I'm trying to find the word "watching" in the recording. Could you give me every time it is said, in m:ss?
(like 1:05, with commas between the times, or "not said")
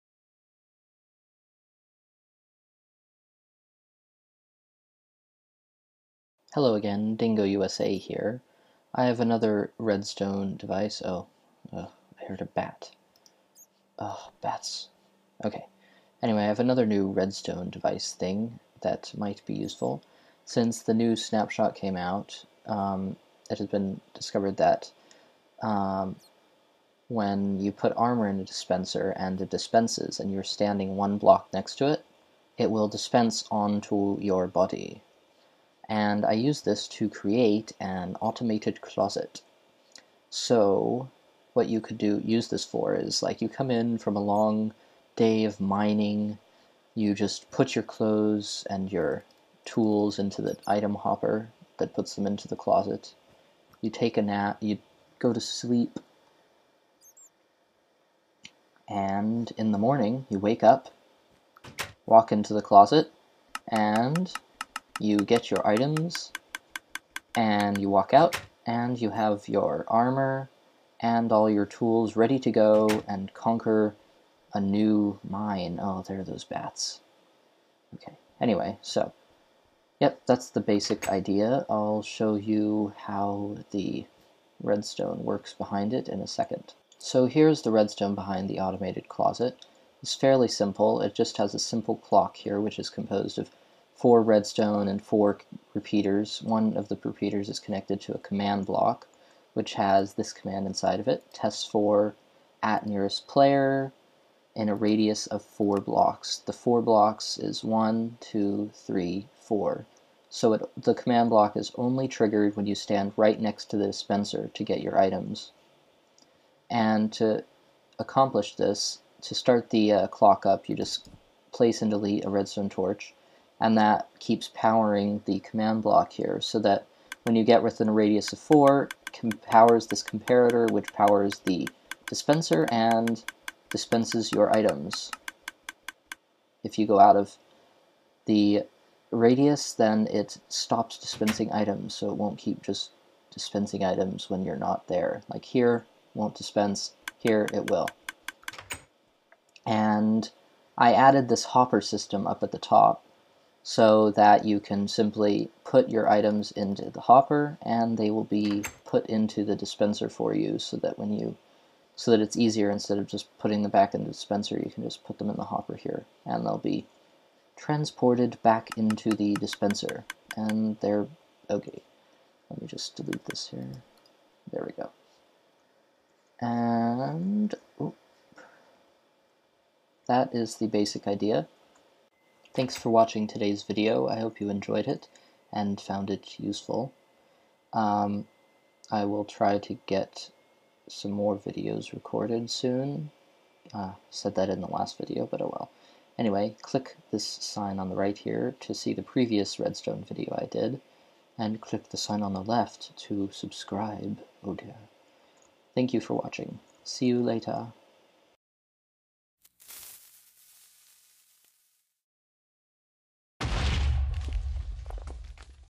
3:02, 3:26.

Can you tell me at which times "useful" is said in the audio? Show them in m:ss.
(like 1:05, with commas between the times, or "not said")
0:19, 3:06.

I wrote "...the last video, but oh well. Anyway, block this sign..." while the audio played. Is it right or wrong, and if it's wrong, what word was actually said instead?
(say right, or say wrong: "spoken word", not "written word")
wrong: "click", not "block".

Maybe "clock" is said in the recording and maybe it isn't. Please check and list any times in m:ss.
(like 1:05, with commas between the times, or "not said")
1:31, 2:00.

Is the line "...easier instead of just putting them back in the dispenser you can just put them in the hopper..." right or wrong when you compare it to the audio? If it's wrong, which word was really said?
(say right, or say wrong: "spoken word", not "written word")
right.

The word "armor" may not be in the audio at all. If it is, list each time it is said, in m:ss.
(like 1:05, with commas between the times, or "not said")
0:27, 1:09.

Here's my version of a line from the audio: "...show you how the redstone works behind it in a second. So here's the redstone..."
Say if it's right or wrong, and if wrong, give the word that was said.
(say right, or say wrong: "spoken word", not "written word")
right.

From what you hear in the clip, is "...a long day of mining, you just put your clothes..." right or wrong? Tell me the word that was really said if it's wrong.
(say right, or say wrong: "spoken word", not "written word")
right.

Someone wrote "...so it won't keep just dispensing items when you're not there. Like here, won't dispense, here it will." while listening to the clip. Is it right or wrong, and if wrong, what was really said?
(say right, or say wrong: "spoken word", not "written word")
right.